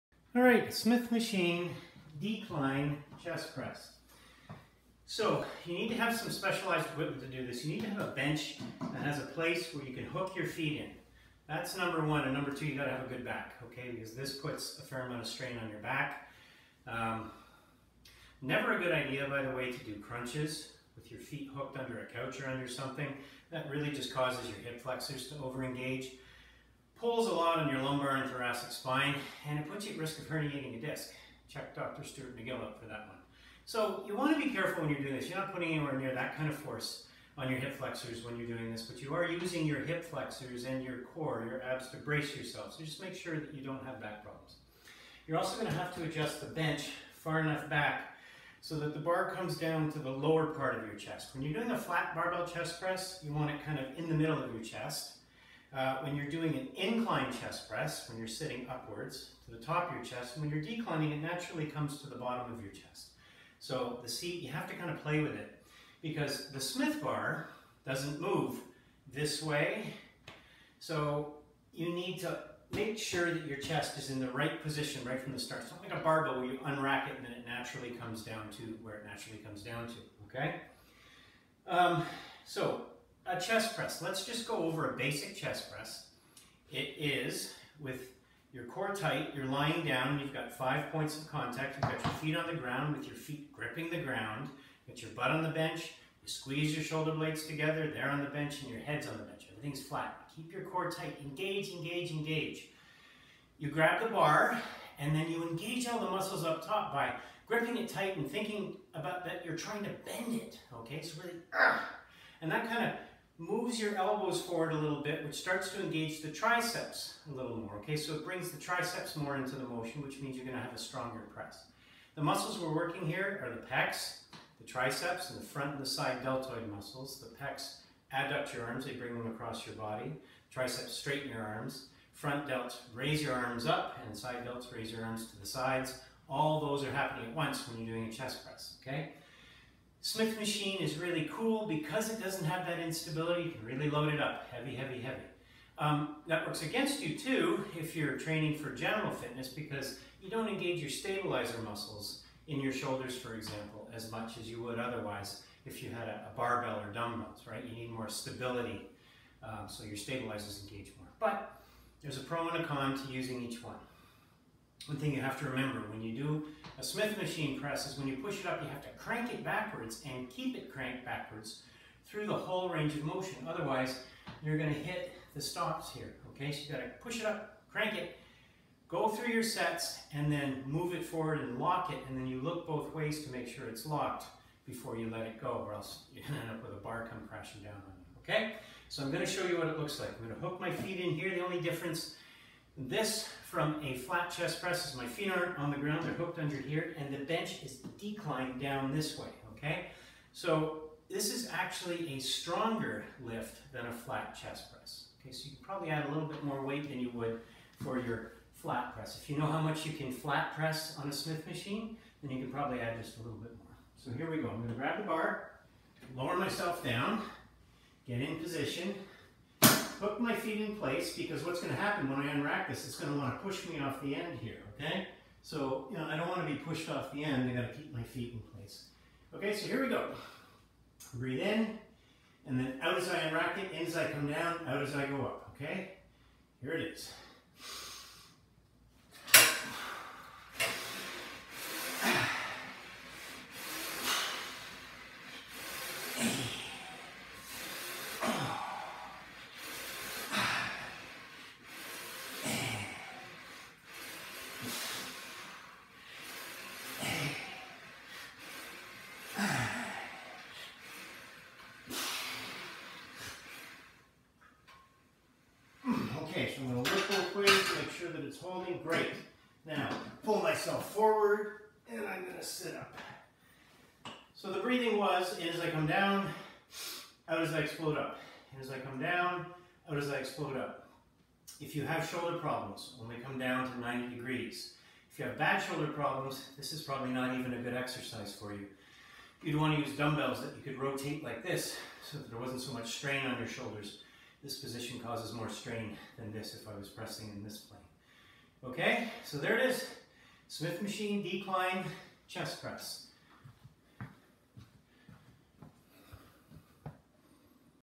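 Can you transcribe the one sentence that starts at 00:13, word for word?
Because this puts a fair amount of strain on your back.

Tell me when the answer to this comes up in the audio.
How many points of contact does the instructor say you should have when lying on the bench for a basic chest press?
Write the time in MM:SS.
01:30.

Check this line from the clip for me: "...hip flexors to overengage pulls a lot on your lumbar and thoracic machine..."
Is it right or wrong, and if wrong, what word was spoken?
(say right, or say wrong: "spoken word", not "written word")
wrong: "spine", not "machine".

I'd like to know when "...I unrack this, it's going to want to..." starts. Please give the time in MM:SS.
03:42.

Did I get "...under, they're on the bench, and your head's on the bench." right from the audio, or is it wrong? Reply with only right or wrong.
wrong.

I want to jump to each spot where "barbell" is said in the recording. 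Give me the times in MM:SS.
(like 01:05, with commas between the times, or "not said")
00:52, 01:16, 02:36.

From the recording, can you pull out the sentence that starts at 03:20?
So this is actually a stronger lift than a flat chest press.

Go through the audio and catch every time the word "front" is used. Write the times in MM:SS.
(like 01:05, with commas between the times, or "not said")
02:05, 02:12.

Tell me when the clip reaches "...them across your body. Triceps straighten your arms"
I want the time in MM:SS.
02:09.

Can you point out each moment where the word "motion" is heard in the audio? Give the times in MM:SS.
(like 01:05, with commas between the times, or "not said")
01:59, 02:53.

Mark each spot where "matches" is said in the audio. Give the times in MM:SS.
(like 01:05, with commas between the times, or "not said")
not said.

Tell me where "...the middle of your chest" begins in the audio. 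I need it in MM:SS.
00:54.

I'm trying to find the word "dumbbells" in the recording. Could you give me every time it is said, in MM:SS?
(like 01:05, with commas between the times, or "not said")
02:36, 04:49.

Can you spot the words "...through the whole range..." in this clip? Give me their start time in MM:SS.
02:52.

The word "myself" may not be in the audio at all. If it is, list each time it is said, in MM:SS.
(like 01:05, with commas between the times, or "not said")
03:36, 04:30.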